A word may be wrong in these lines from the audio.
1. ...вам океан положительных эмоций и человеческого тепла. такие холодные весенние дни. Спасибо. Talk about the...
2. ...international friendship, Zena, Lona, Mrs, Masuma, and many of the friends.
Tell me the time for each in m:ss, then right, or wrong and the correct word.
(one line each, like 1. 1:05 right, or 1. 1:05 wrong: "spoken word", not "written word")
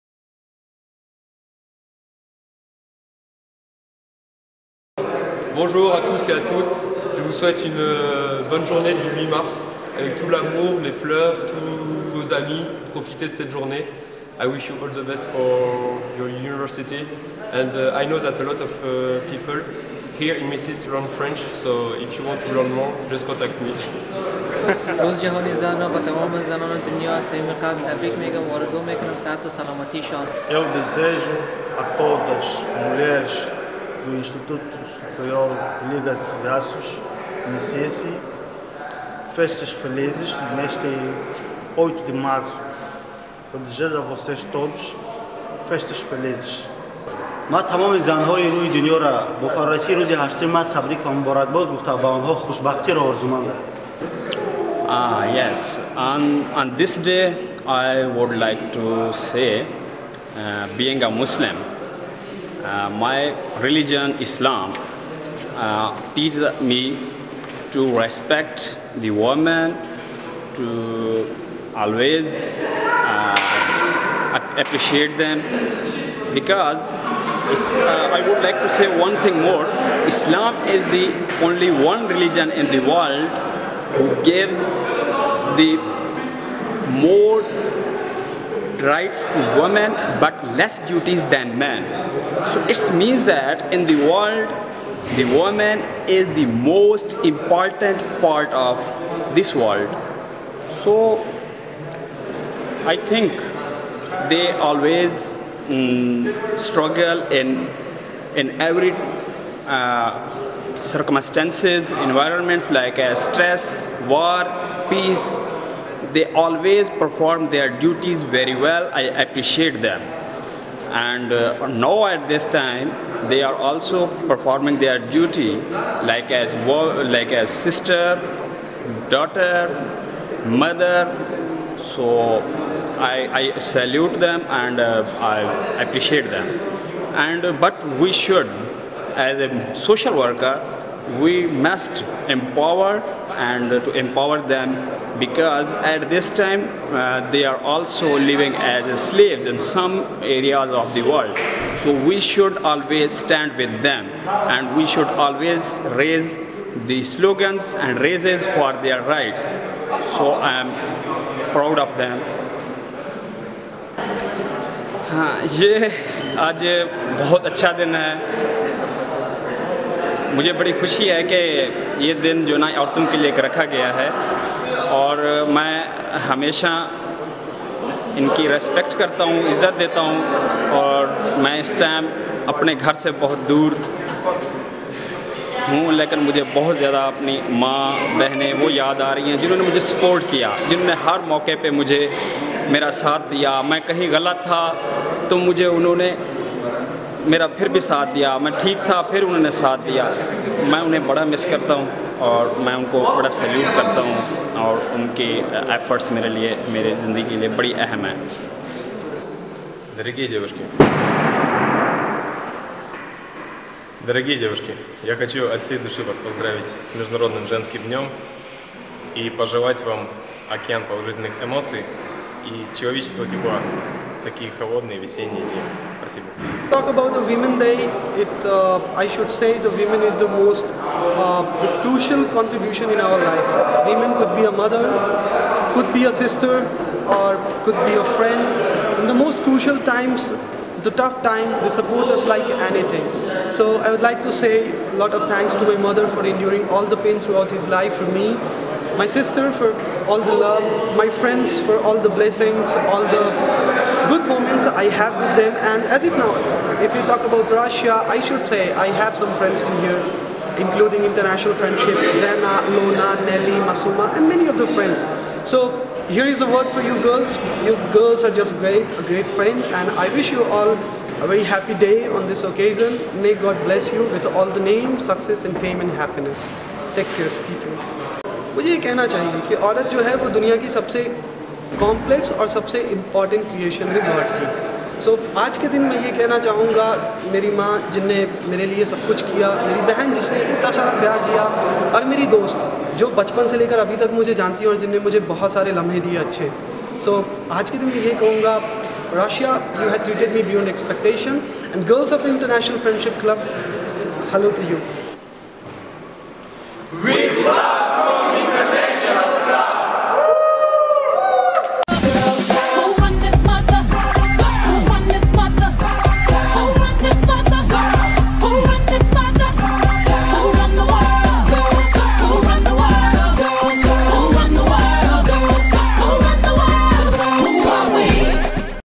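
1. 3:39 right
2. 4:21 wrong: "Nelly", not "Mrs".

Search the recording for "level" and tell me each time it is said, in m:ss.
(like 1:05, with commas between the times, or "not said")
not said.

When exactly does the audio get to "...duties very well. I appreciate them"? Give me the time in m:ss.
1:57.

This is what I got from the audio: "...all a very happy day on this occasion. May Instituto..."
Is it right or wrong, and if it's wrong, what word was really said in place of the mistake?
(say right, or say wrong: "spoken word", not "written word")
wrong: "God", not "Instituto".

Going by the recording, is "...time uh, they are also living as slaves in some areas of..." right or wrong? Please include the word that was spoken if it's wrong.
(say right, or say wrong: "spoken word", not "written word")
right.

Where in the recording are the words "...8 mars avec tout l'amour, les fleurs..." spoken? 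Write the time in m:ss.
0:09.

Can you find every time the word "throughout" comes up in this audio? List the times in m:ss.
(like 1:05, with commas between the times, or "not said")
4:07.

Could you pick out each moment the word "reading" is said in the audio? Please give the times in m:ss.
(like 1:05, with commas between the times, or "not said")
not said.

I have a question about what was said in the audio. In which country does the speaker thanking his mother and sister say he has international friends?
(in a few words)
Russia.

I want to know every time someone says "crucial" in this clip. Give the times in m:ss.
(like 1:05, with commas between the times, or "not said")
3:51, 3:59.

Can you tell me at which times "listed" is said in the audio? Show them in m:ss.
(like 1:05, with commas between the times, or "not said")
not said.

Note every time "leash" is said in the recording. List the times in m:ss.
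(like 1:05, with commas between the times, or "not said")
not said.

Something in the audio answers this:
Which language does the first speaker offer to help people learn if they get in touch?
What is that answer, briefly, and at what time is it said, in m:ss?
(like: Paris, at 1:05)
French, at 0:21.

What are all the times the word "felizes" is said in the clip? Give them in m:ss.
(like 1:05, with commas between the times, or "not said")
0:39, 0:45.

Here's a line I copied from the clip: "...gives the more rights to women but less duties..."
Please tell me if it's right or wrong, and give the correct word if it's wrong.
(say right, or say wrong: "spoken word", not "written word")
right.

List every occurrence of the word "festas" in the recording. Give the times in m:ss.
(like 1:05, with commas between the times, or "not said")
0:39, 0:45.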